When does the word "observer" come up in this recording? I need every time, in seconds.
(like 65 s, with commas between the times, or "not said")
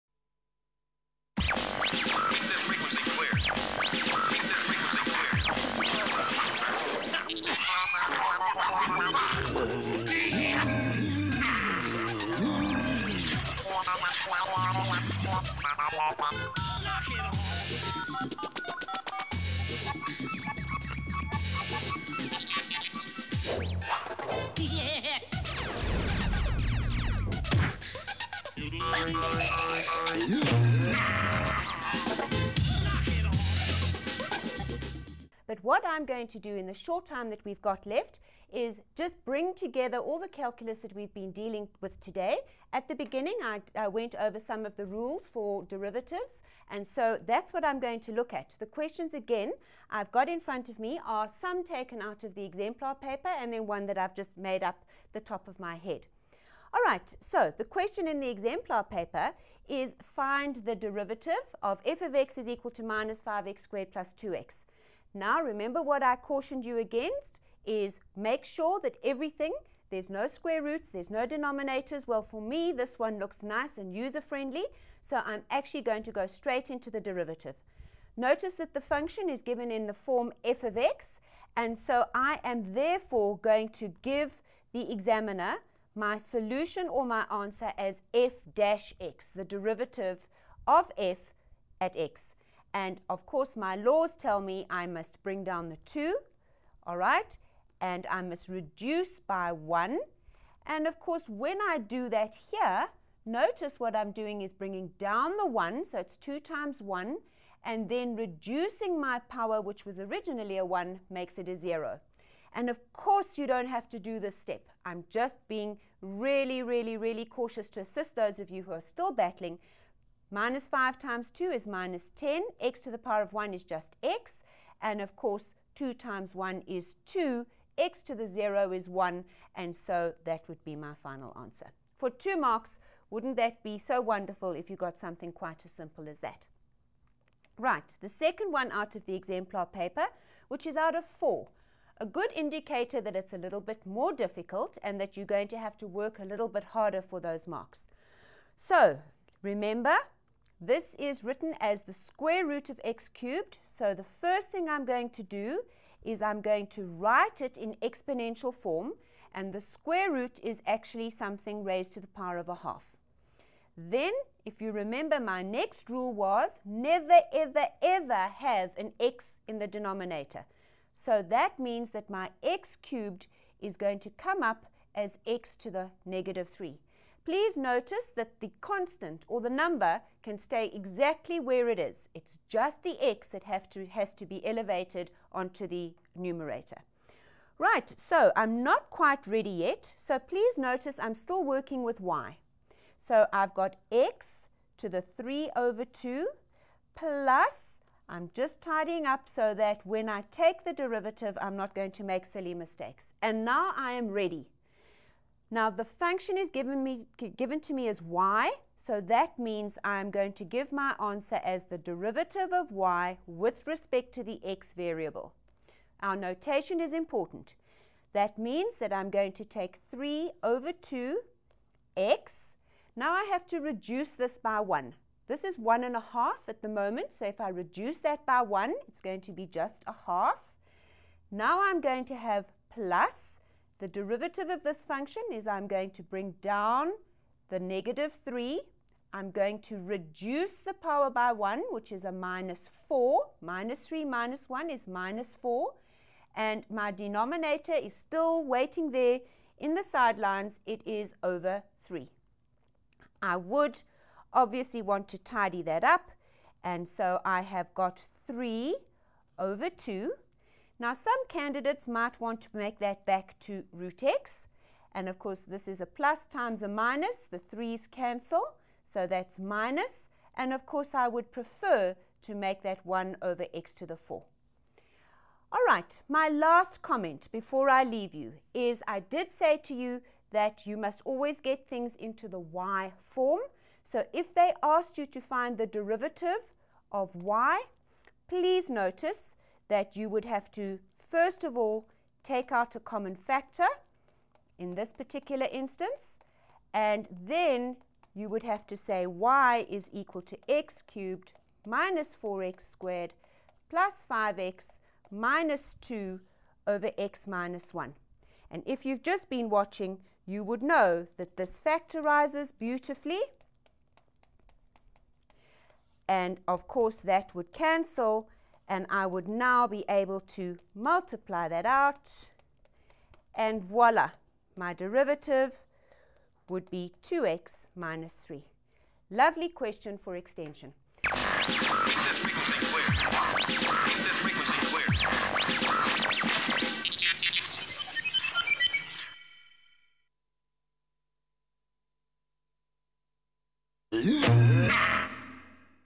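not said.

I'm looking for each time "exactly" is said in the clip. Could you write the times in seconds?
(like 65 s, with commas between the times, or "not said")
180 s.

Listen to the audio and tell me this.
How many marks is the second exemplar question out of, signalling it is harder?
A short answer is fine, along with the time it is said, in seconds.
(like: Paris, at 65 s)
4, at 141 s.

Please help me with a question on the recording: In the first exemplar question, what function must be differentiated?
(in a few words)
-5x^2 + 2x.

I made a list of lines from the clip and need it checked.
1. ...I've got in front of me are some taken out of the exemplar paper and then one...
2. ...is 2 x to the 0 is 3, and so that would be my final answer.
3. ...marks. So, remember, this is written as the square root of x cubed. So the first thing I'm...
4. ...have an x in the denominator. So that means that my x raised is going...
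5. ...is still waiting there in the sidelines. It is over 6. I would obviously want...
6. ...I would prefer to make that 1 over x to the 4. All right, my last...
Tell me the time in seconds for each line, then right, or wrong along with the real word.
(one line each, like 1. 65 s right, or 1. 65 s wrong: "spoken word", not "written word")
1. 49 s right
2. 126 s wrong: "1", not "3"
3. 147 s right
4. 168 s wrong: "cubed", not "raised"
5. 247 s wrong: "3", not "6"
6. 270 s right.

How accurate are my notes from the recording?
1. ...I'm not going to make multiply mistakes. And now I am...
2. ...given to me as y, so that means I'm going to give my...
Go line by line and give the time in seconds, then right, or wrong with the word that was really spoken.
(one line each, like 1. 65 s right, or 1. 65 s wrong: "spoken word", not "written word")
1. 201 s wrong: "silly", not "multiply"
2. 207 s right.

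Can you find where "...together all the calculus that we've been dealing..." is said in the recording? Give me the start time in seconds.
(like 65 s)
39 s.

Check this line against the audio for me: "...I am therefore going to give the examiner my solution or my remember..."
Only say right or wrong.
wrong.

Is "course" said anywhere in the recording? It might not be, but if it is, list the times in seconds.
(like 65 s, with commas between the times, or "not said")
93 s, 100 s, 112 s, 125 s, 265 s, 270 s, 316 s.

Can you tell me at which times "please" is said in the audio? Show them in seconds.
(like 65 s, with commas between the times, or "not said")
177 s, 190 s, 288 s.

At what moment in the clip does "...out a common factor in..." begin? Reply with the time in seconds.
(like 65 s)
292 s.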